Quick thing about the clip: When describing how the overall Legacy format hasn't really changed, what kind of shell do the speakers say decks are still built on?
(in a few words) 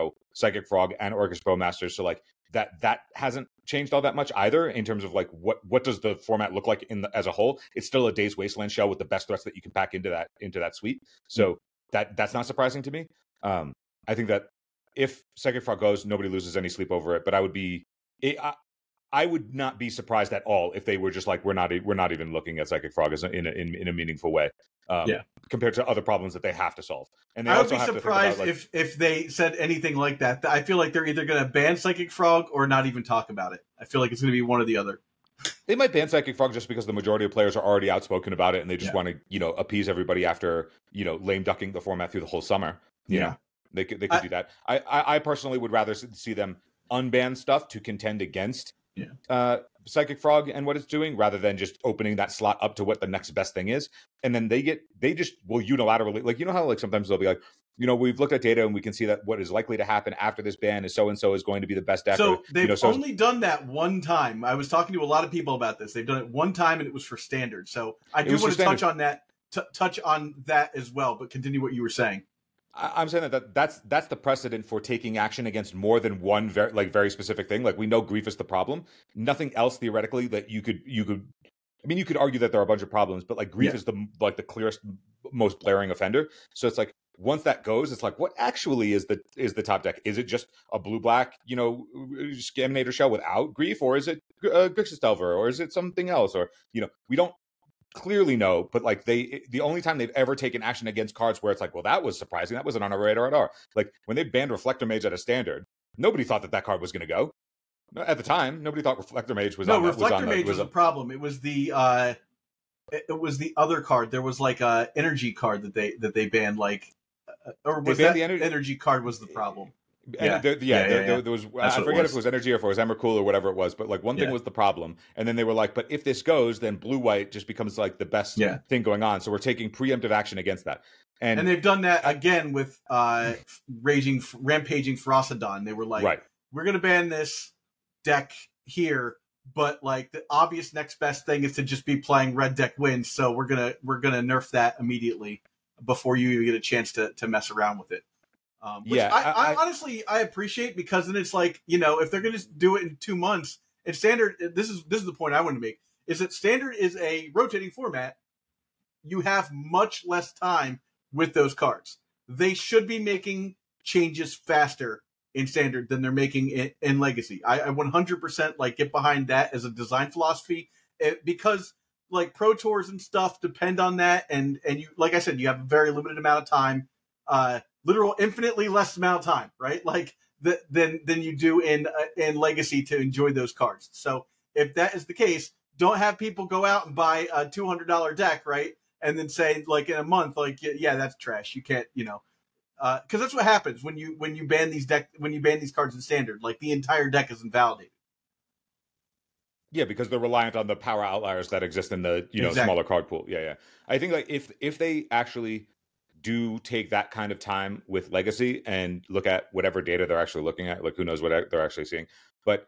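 Daze Wasteland shell.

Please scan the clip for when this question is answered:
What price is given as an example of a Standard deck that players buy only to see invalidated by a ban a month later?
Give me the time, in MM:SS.
03:07.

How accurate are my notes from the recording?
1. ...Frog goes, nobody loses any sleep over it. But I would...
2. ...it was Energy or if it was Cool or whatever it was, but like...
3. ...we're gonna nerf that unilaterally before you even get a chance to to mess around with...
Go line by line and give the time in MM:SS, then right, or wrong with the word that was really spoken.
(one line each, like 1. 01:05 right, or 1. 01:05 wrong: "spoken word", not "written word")
1. 00:15 right
2. 02:02 right
3. 02:23 wrong: "immediately", not "unilaterally".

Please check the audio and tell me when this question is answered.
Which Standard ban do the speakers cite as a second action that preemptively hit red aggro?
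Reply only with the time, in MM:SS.
02:14.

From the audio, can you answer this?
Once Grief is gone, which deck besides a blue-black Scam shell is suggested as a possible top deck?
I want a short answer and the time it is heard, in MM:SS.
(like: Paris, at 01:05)
Grixis Delver, at 01:34.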